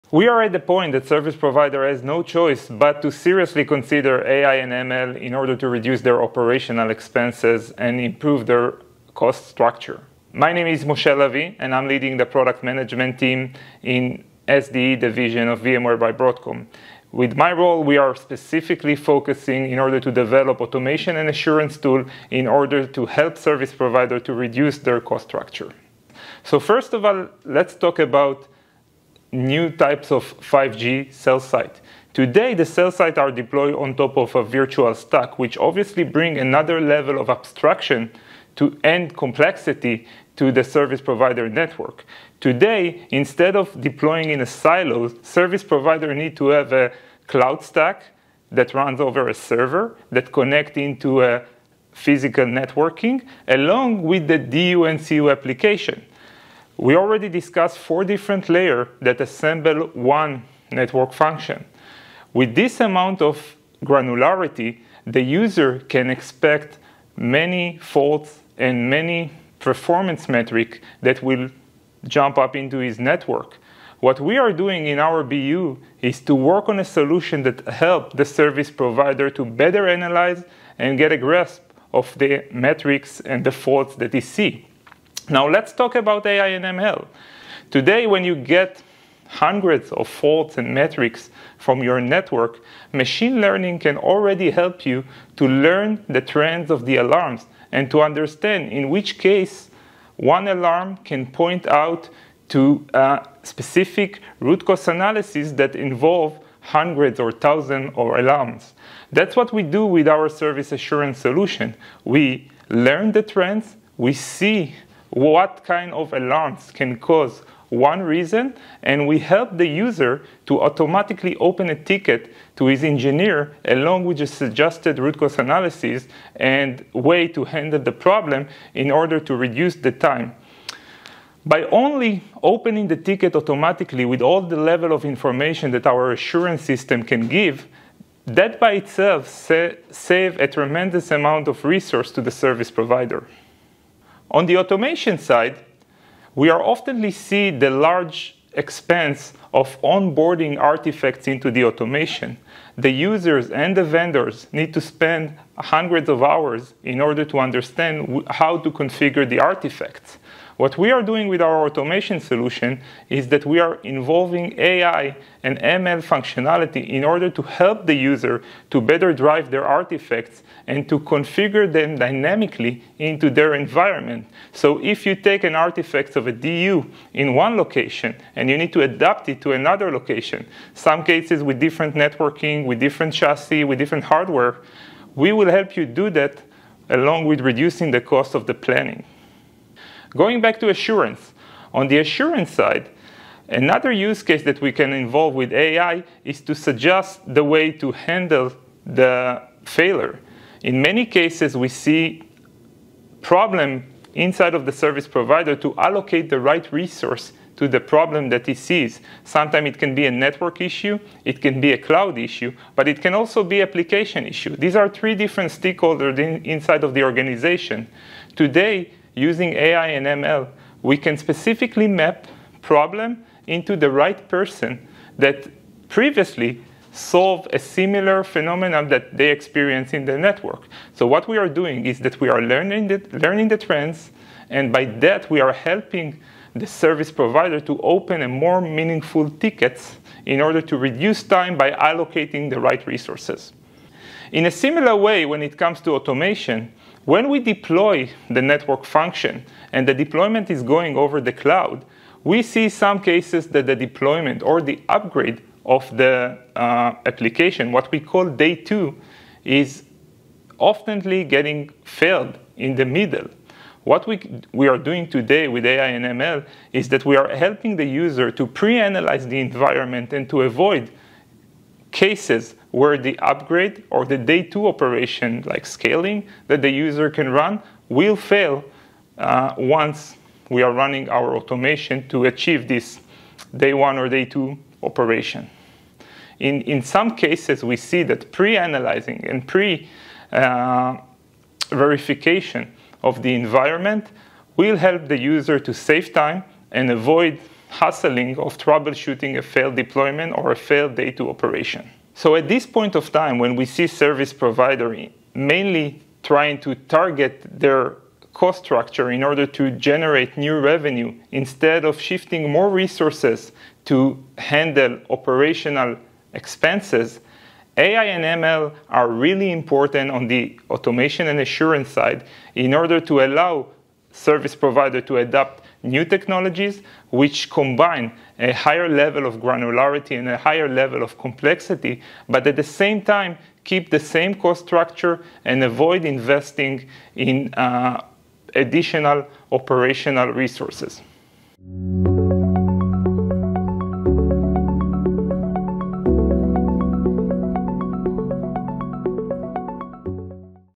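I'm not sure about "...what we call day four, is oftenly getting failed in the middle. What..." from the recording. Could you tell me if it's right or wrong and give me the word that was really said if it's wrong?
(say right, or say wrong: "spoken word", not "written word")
wrong: "two", not "four".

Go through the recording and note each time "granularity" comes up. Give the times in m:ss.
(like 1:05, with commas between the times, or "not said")
1:03, 5:29.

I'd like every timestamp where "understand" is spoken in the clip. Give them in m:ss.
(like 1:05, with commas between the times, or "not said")
1:38, 2:37.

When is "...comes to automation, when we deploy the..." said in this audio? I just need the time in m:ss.
4:05.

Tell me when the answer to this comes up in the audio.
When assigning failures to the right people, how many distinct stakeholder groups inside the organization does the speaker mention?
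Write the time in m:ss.
3:34.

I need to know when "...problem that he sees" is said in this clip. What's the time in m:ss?
3:27.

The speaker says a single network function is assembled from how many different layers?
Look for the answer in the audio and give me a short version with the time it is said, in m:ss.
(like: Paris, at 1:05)
4, at 0:57.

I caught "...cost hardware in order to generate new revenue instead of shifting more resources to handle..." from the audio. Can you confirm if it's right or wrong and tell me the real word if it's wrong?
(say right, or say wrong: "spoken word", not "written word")
wrong: "structure", not "hardware".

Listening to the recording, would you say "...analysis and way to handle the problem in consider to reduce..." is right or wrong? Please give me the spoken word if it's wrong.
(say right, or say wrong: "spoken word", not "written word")
wrong: "order", not "consider".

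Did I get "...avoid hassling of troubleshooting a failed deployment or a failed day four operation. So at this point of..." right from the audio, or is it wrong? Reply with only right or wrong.
wrong.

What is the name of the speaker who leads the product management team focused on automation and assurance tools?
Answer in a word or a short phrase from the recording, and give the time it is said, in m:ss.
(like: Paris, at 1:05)
Moshe Lavi, at 0:10.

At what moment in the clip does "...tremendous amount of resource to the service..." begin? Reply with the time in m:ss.
2:20.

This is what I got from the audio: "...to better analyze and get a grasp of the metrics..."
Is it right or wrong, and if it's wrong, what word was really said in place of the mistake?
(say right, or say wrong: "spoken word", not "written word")
right.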